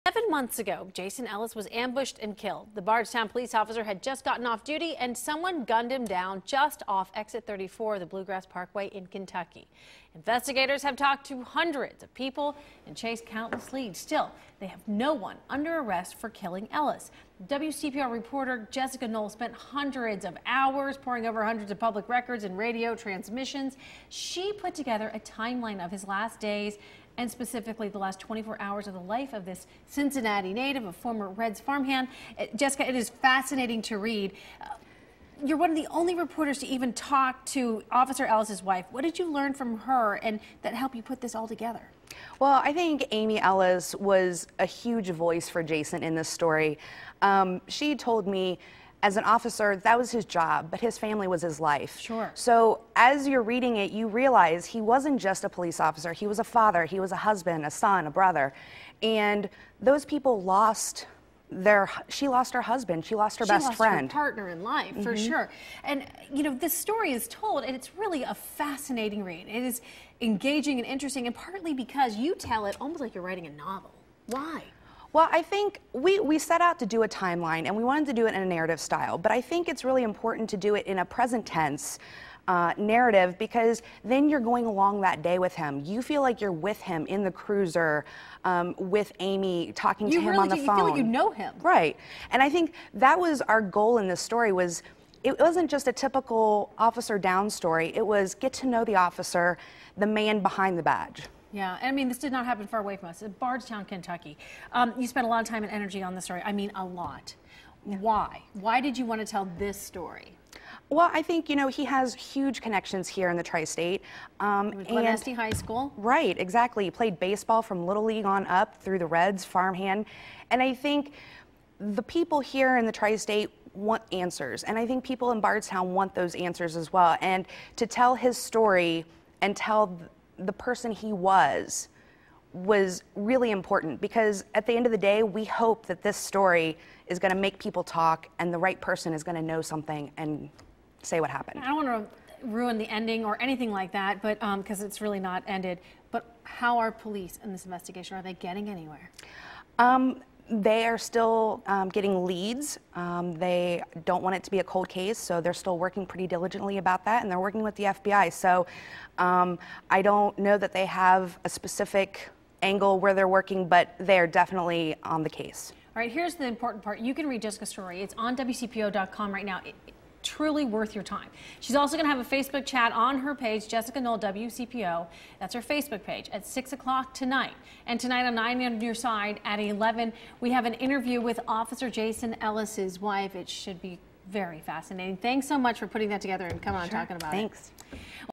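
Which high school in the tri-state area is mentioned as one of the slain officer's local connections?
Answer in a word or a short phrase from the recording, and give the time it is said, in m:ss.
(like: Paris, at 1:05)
Glen Este High School, at 1:54.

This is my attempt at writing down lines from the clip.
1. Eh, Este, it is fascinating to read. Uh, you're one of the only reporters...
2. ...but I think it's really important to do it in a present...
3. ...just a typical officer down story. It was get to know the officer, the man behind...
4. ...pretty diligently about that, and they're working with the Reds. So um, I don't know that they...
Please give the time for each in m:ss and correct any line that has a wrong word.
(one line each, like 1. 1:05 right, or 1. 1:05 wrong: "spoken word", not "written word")
1. 0:32 wrong: "Jessica", not "Este"
2. 1:19 right
3. 1:35 right
4. 2:36 wrong: "FBI", not "Reds".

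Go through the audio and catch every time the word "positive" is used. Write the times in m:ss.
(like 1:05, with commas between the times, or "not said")
not said.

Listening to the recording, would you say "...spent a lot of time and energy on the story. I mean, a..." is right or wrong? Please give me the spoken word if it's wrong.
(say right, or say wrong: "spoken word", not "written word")
right.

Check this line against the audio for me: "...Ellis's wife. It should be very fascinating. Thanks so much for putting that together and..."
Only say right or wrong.
right.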